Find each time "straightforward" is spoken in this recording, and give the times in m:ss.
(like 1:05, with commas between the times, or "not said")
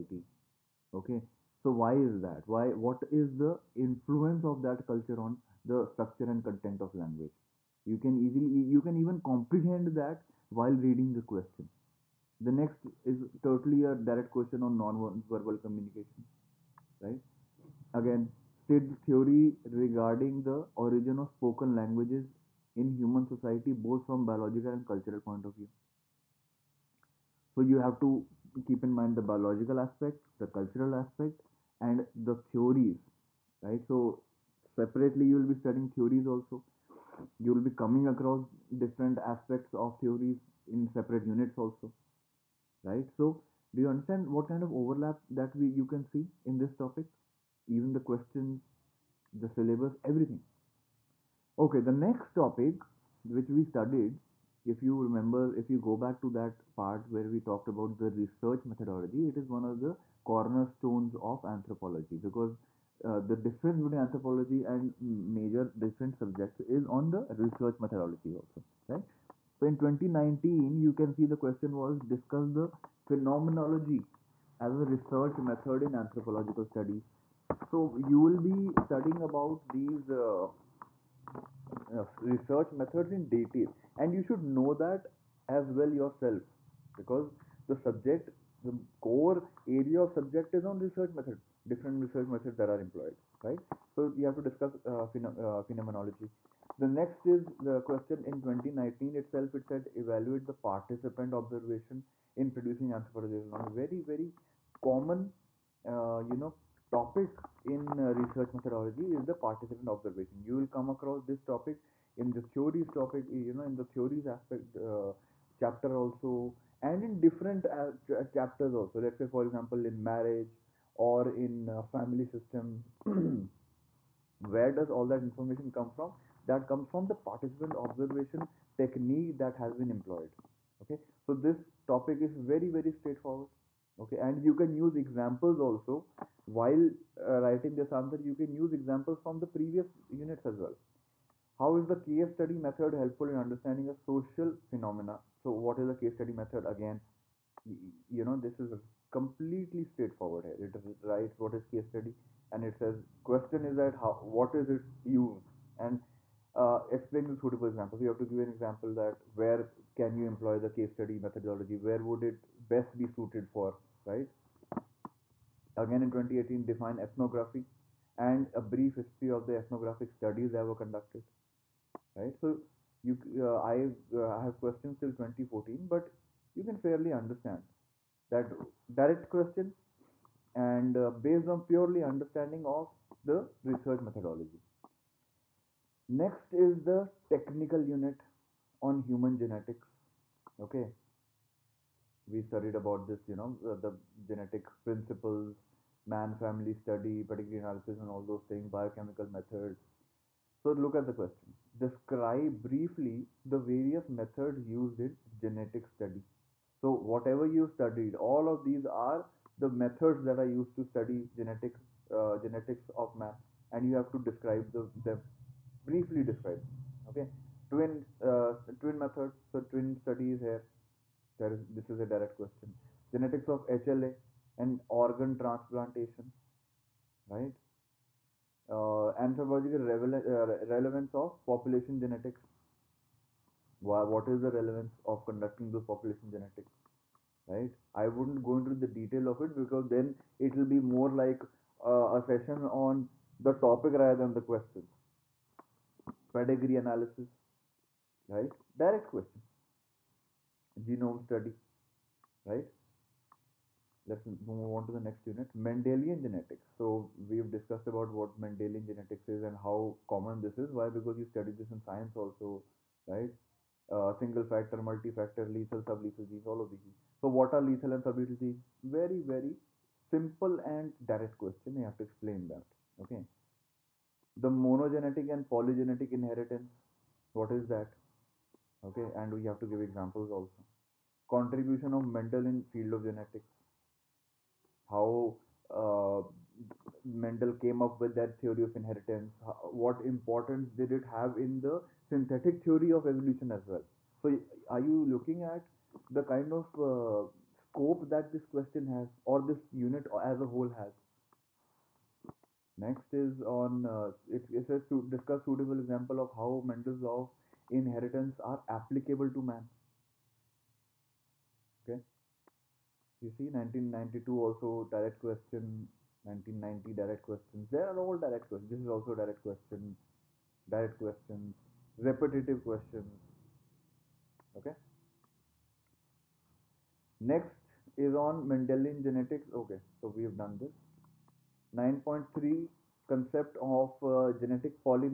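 2:12, 2:29.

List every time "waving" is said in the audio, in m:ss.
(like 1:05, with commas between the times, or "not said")
not said.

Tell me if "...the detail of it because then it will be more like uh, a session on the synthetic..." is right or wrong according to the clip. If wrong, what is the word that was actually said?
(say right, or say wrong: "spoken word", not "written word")
wrong: "topic", not "synthetic".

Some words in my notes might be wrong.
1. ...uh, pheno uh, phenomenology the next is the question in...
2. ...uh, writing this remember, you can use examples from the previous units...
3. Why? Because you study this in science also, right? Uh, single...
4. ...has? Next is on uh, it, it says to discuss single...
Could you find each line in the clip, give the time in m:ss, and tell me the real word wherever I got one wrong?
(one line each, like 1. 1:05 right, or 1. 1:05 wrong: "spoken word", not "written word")
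1. 1:34 right
2. 2:17 wrong: "answer", not "remember"
3. 4:20 right
4. 5:00 wrong: "suitable", not "single".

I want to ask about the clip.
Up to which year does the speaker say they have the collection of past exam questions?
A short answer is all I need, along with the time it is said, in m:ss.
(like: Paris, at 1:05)
2014, at 2:55.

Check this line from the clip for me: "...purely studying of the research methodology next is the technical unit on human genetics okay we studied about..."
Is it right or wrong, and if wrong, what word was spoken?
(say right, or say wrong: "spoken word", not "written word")
wrong: "understanding", not "studying".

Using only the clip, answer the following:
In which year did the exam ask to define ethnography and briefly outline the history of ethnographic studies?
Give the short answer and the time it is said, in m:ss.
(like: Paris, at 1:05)
2018, at 2:46.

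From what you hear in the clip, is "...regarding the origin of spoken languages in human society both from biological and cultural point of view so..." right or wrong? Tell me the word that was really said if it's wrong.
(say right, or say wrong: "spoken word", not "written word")
right.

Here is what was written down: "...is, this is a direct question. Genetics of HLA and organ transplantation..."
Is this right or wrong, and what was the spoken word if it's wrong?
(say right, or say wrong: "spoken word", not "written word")
right.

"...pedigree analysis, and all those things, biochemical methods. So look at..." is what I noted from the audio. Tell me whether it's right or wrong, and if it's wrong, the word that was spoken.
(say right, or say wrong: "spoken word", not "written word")
right.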